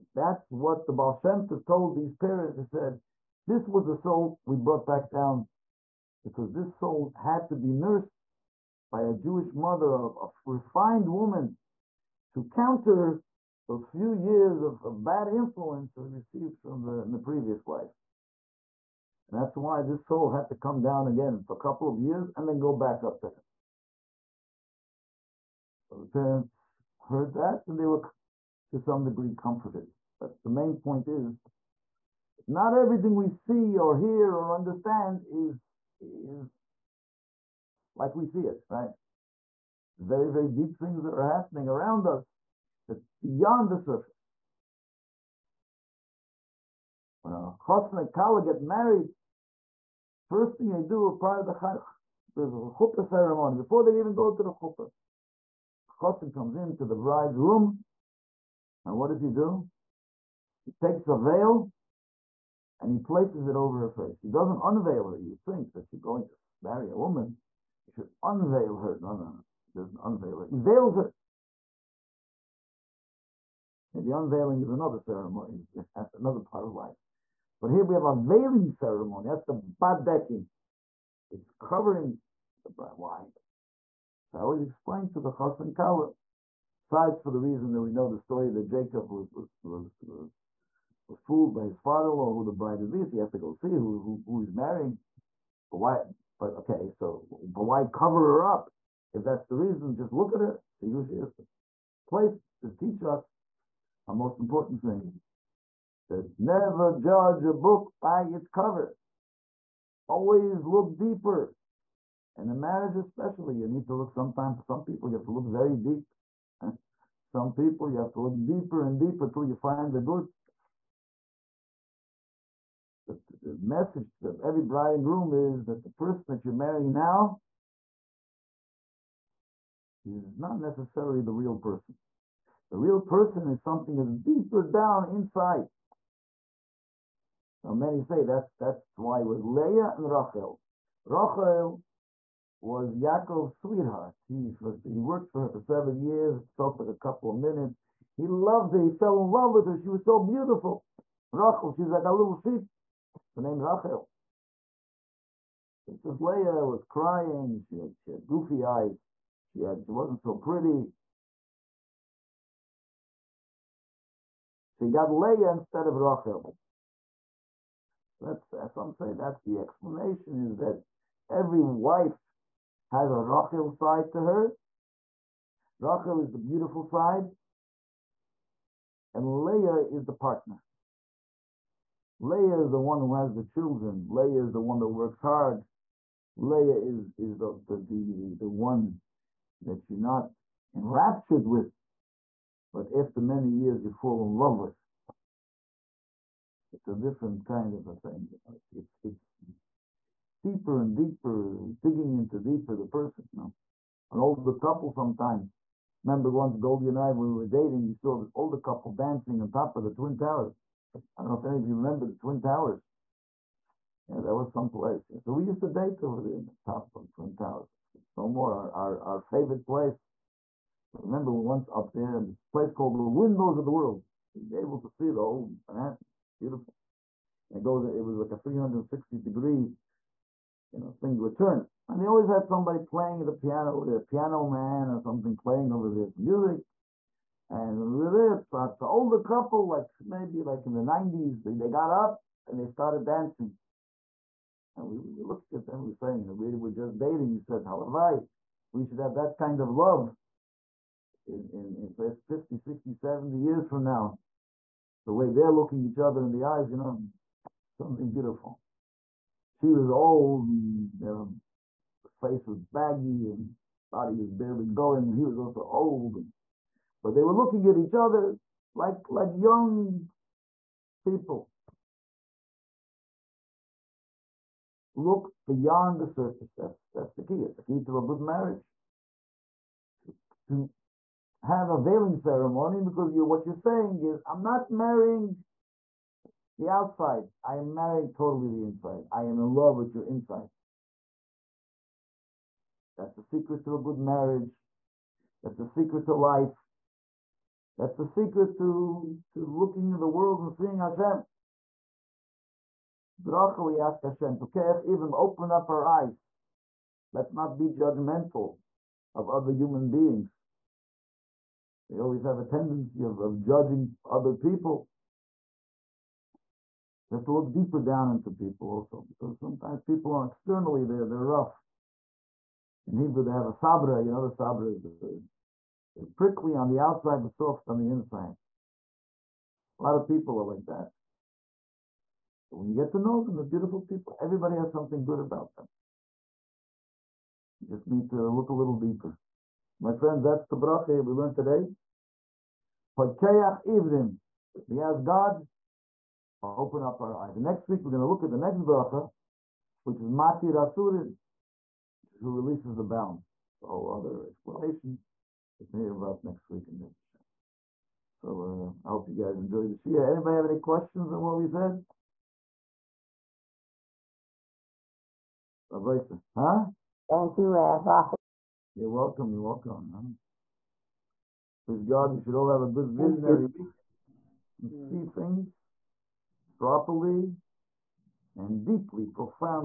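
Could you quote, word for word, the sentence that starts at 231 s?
And they always had somebody playing the piano, the piano man or something playing over this music.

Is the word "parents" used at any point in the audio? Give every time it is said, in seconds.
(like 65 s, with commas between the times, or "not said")
2 s, 26 s.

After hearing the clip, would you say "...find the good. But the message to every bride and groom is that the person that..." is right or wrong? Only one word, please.
right.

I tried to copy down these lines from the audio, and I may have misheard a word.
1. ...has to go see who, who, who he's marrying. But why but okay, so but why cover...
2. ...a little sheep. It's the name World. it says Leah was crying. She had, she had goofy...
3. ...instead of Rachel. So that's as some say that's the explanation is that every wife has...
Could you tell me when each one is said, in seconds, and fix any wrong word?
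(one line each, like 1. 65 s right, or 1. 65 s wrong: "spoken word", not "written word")
1. 93 s right
2. 152 s wrong: "Rachel", not "World"
3. 165 s right.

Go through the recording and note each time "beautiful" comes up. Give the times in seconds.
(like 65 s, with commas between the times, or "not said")
150 s, 176 s, 226 s, 258 s, 333 s.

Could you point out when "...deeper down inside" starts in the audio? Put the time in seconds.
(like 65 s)
134 s.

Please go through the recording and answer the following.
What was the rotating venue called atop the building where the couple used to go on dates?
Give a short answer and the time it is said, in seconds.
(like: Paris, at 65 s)
Windows of the World, at 223 s.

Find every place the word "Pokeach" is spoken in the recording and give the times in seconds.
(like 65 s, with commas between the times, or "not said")
304 s.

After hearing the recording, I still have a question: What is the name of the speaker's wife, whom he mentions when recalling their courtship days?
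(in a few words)
Goldie.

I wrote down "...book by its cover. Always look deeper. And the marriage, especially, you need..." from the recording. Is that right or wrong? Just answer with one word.
right.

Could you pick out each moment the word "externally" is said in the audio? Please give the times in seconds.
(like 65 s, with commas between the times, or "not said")
320 s.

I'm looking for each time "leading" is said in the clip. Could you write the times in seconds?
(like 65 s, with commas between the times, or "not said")
not said.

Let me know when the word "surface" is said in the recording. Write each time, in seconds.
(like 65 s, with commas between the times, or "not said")
43 s, 276 s.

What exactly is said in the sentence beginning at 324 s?
You know, the sabra is a prickly on the outside, but soft on the inside.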